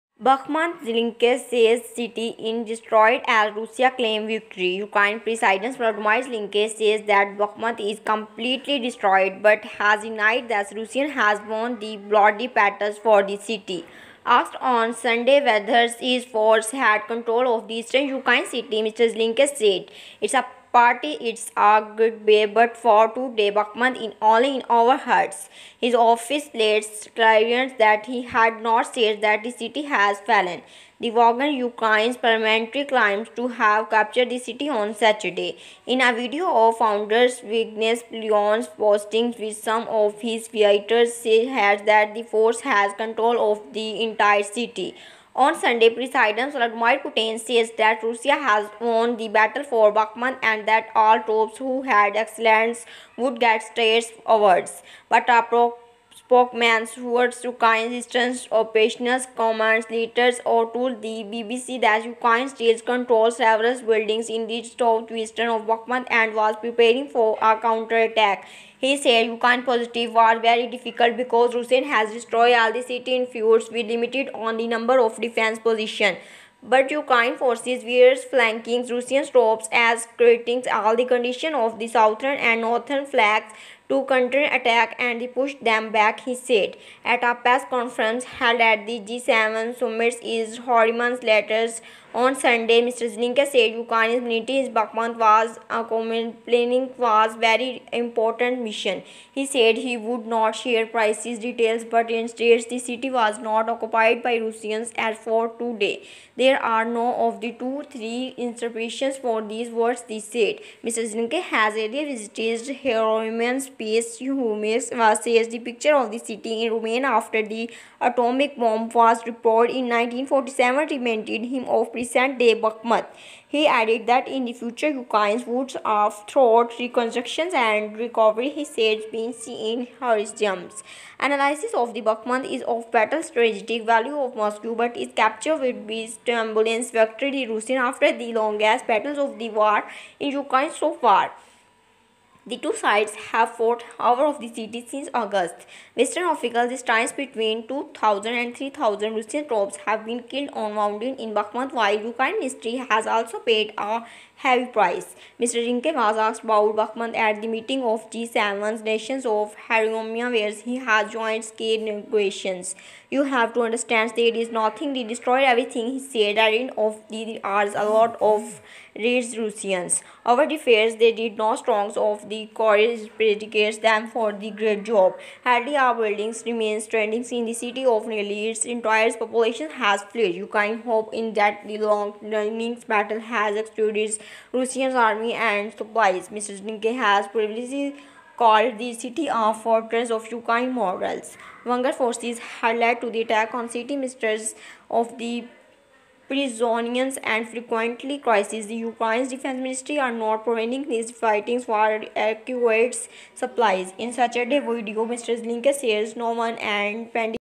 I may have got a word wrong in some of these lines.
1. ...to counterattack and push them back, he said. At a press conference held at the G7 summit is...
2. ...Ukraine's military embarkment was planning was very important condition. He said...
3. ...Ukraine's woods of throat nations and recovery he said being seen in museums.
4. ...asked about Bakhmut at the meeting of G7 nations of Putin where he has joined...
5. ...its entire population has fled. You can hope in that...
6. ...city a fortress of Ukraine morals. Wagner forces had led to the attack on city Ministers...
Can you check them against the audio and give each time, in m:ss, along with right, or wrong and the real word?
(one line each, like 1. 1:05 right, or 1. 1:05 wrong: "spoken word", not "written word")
1. 1:23 right
2. 1:33 wrong: "mission", not "condition"
3. 2:04 wrong: "reconstructions", not "nations"
4. 2:36 wrong: "Haromia", not "Putin"
5. 2:58 right
6. 3:08 right.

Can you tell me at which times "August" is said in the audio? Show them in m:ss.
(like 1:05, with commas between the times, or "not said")
2:25.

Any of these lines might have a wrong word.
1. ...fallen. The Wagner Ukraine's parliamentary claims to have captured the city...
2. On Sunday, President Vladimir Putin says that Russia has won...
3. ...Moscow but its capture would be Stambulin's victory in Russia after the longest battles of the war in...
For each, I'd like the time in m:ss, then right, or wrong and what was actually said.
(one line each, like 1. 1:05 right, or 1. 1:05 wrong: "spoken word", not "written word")
1. 0:30 right
2. 0:45 right
3. 2:14 right.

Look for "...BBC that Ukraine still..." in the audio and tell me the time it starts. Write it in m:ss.
1:01.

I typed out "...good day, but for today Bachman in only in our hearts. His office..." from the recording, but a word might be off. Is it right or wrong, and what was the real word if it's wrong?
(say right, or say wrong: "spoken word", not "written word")
right.